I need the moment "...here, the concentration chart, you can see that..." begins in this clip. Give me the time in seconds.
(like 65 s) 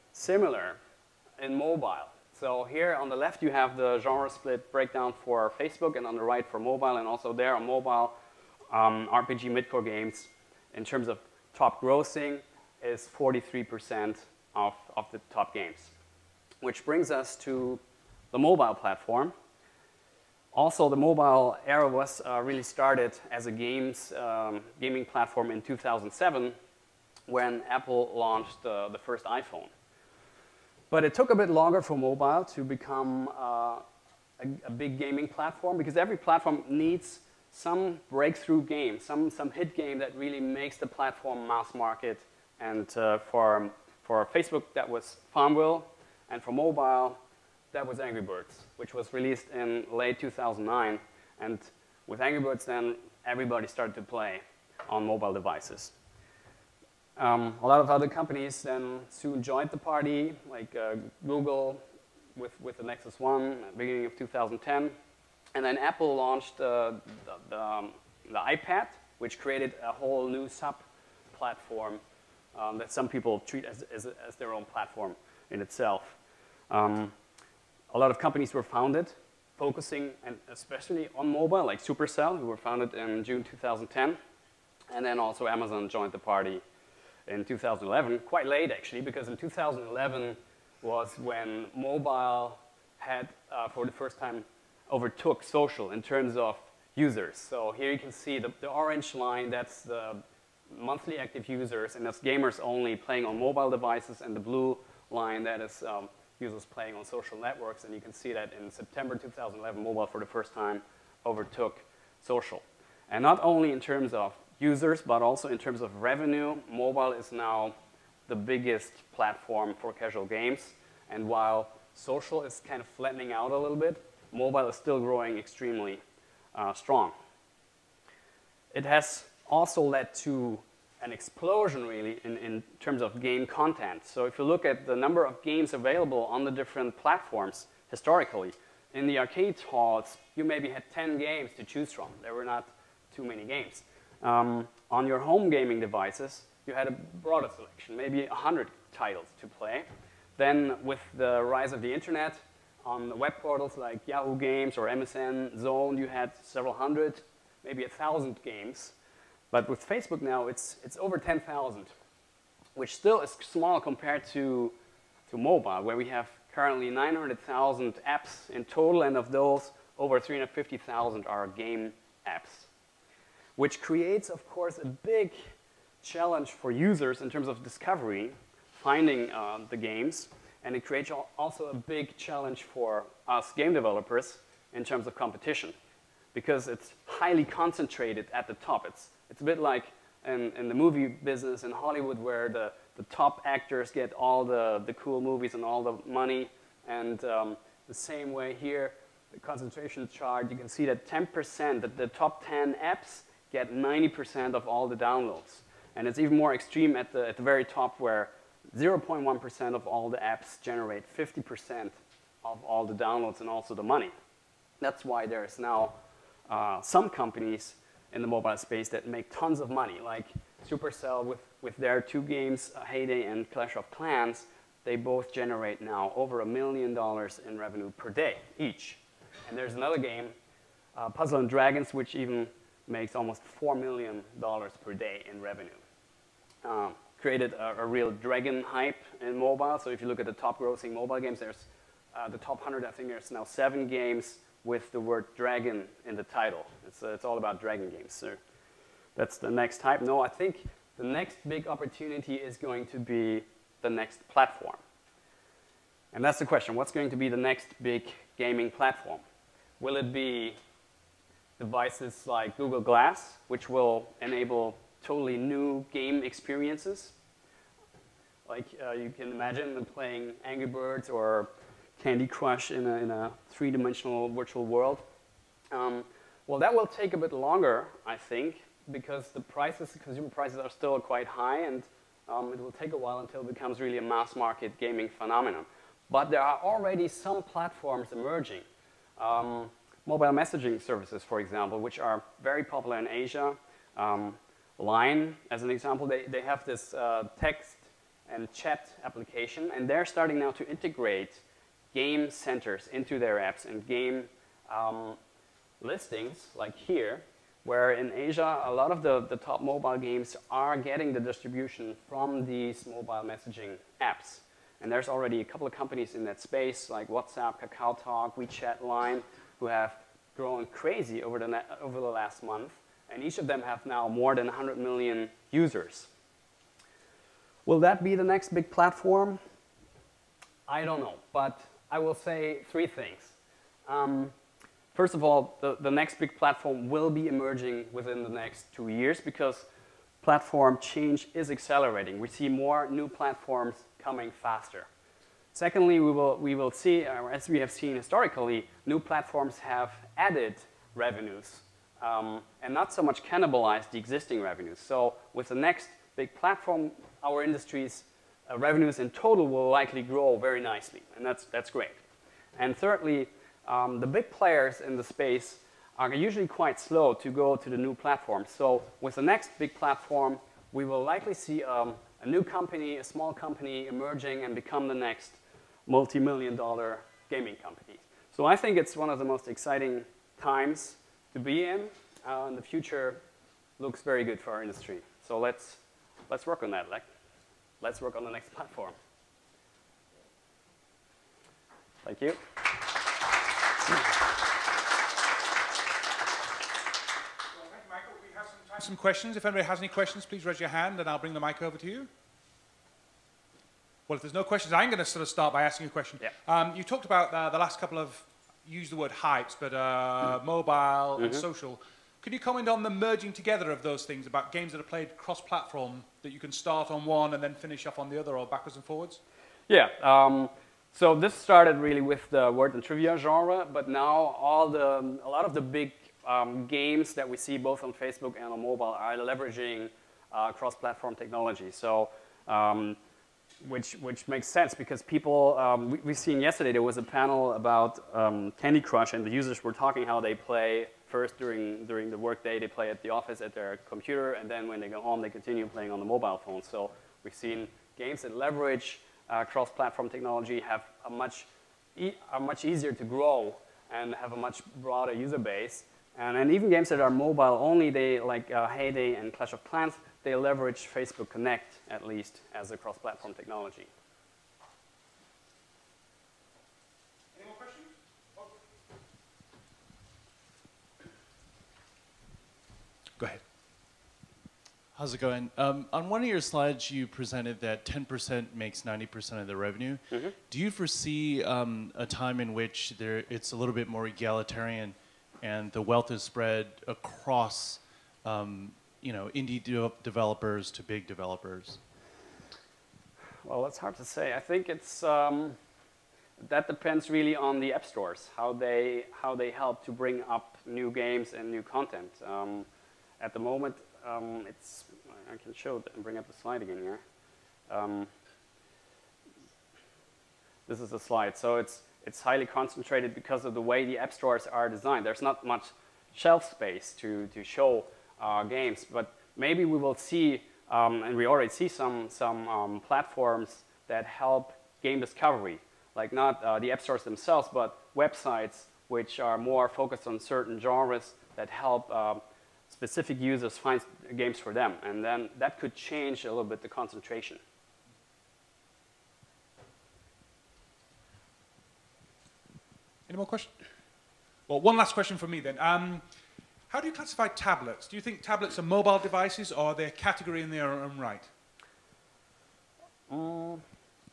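198 s.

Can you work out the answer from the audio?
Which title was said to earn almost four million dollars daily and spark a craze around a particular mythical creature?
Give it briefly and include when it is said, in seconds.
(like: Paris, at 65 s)
Puzzle and Dragons, at 231 s.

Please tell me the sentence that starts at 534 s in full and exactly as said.
And then that could change a little bit the concentration.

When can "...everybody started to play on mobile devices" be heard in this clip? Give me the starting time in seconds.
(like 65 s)
53 s.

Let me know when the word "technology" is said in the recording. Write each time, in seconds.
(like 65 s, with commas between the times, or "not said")
431 s, 450 s, 463 s.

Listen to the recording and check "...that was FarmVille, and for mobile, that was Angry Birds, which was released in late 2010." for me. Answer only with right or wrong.
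wrong.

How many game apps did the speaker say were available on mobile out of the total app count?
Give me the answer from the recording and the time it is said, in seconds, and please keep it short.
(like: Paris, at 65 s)
350,000, at 170 s.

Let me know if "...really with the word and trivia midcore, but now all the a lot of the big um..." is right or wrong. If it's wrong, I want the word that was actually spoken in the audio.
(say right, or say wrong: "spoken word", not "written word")
wrong: "genre", not "midcore".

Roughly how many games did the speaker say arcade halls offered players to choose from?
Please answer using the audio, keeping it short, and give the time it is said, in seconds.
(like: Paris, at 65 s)
10, at 140 s.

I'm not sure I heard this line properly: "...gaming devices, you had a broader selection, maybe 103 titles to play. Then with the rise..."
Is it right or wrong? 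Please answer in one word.
wrong.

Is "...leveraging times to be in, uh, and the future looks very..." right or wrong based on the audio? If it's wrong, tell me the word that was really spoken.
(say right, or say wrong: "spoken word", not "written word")
wrong: "exciting", not "leveraging".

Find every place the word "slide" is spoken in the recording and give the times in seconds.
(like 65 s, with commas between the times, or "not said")
476 s, 506 s, 510 s.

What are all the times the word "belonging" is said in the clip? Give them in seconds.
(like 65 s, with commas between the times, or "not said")
not said.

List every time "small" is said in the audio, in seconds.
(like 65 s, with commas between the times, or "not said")
163 s, 373 s.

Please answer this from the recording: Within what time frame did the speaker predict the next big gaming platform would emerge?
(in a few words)
2 years.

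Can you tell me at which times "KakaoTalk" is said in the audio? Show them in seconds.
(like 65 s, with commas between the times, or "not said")
317 s.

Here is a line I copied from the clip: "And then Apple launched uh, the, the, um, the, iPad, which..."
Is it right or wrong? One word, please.
right.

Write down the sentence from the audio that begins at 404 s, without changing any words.
Well, if there's no questions, I'm going to sort of start by asking you a question.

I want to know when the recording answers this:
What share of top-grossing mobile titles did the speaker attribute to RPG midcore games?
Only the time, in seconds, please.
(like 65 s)
13 s.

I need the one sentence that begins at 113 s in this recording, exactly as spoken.
And not only in terms of users, but also in terms of revenue, mobile is now the biggest platform for casual games.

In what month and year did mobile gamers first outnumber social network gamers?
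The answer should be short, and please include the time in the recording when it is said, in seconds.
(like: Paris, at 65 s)
September 2011, at 108 s.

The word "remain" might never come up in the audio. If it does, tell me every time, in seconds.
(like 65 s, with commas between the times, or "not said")
not said.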